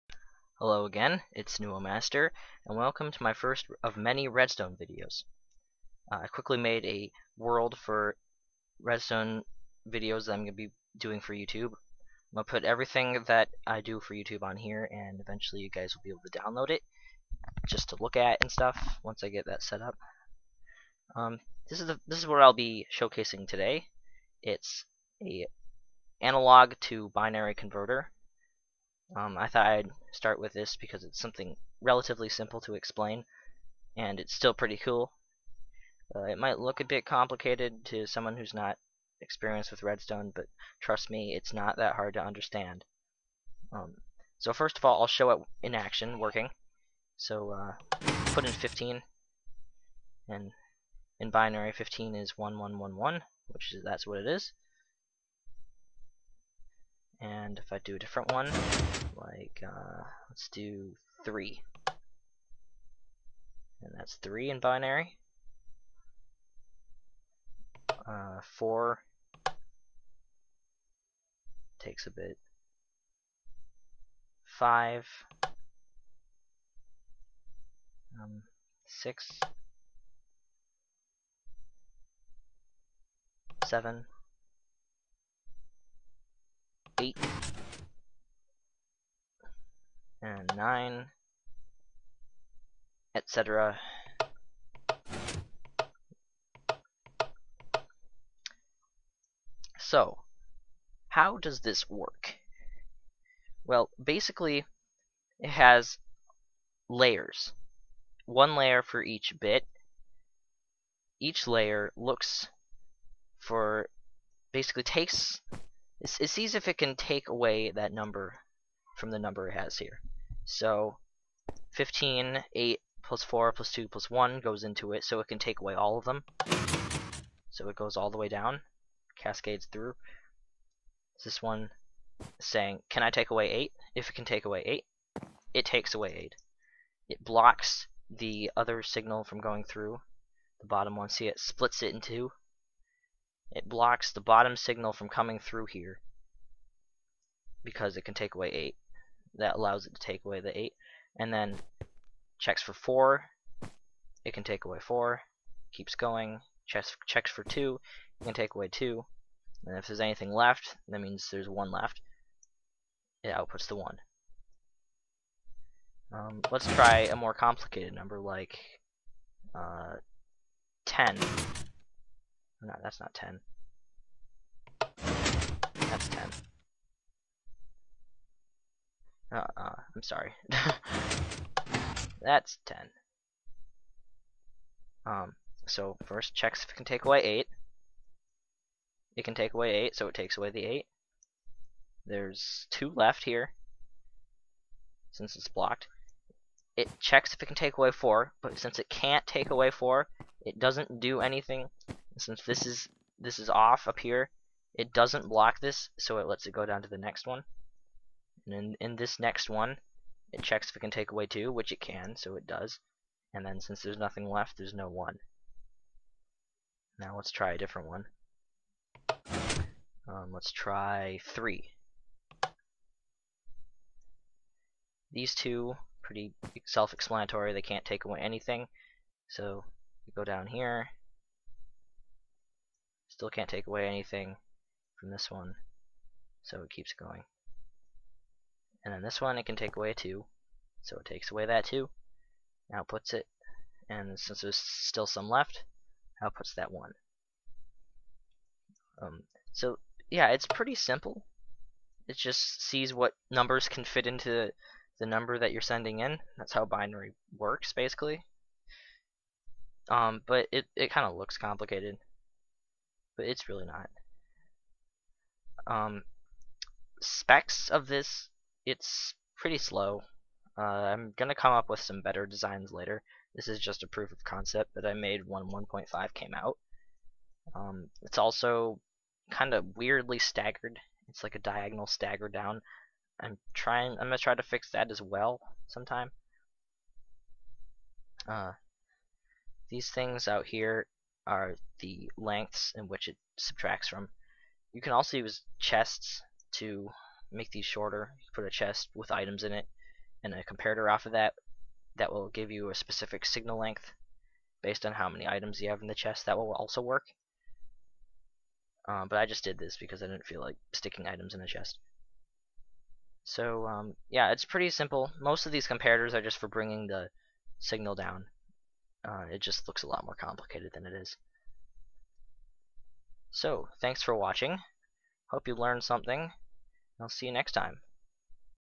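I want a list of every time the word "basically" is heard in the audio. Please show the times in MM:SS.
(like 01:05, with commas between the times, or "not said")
01:44, 01:54, 04:17.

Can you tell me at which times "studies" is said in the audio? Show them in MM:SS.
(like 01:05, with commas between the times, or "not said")
not said.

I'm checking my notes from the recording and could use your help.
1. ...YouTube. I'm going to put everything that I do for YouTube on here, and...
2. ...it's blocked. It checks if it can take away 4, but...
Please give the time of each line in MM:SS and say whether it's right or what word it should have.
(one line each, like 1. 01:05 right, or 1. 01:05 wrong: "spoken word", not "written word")
1. 00:11 right
2. 03:15 right.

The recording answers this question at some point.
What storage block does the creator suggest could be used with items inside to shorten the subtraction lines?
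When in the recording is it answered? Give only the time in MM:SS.
04:55.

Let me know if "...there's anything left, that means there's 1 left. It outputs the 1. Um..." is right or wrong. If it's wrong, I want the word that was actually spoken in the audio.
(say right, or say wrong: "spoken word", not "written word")
right.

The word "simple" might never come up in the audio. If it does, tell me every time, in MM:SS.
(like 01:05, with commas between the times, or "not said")
00:32, 04:10, 05:14.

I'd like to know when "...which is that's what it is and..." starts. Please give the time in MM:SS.
00:53.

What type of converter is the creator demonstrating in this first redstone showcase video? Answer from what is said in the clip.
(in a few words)
analog to binary converter.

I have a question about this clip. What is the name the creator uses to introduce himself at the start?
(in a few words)
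NewoMaster.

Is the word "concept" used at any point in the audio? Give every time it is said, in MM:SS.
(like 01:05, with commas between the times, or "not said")
04:34.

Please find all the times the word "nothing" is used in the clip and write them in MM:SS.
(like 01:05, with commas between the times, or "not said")
03:33.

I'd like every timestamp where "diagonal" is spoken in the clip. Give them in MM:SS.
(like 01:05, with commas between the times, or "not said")
04:41.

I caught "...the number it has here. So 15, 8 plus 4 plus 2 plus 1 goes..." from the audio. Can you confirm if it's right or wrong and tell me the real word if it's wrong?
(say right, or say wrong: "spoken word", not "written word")
right.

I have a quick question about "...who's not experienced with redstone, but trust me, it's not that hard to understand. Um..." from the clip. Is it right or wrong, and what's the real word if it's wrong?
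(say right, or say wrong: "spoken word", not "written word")
right.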